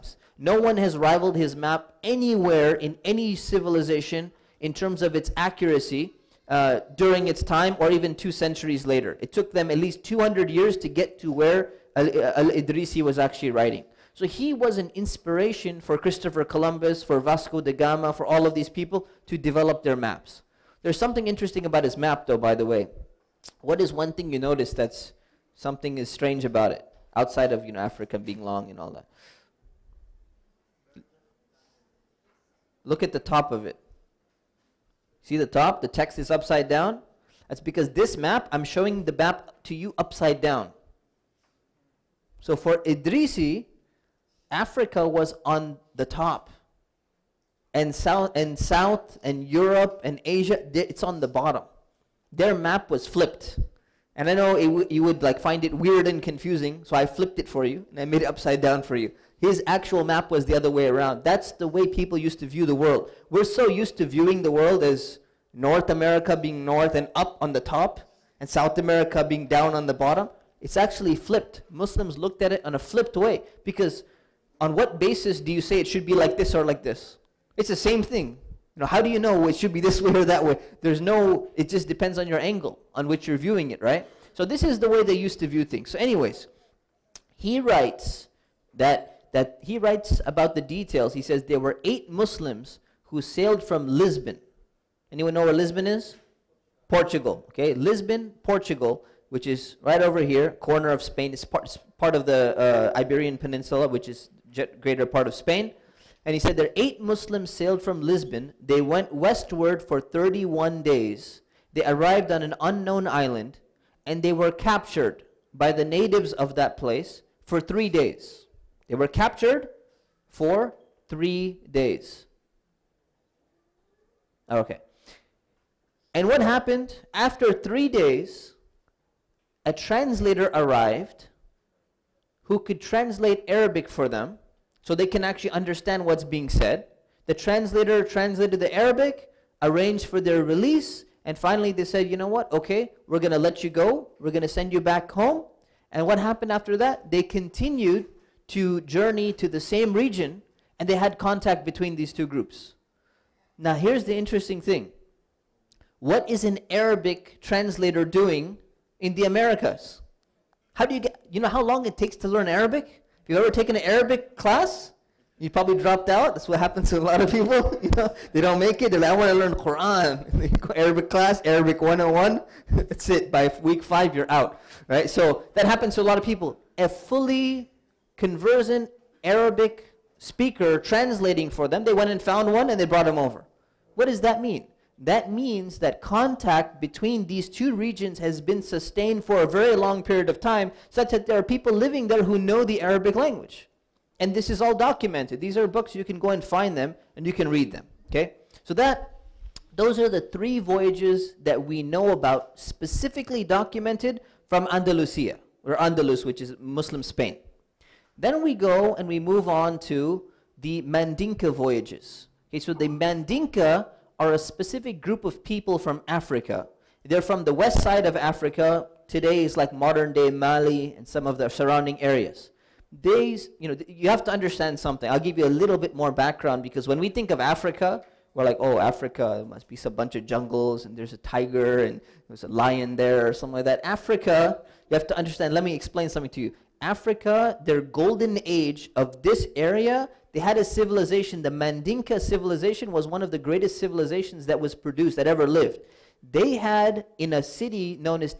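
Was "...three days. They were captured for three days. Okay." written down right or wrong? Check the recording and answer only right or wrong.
right.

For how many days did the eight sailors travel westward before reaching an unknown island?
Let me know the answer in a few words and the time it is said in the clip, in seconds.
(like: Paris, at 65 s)
31, at 110 s.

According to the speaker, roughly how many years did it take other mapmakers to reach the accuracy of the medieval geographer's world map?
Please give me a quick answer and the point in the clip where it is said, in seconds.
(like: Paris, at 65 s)
200 years, at 10 s.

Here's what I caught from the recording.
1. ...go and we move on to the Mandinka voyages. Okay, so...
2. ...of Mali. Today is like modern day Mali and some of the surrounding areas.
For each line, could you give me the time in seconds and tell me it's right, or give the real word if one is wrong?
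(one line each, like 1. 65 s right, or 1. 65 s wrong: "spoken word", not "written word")
1. 208 s right
2. 218 s wrong: "Africa", not "Mali".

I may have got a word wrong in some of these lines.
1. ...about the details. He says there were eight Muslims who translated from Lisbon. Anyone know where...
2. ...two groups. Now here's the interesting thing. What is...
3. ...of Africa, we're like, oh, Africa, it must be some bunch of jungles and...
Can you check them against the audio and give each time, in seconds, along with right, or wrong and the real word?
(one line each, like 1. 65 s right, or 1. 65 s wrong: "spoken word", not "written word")
1. 90 s wrong: "sailed", not "translated"
2. 152 s right
3. 227 s right.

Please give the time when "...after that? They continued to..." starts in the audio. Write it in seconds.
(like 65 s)
146 s.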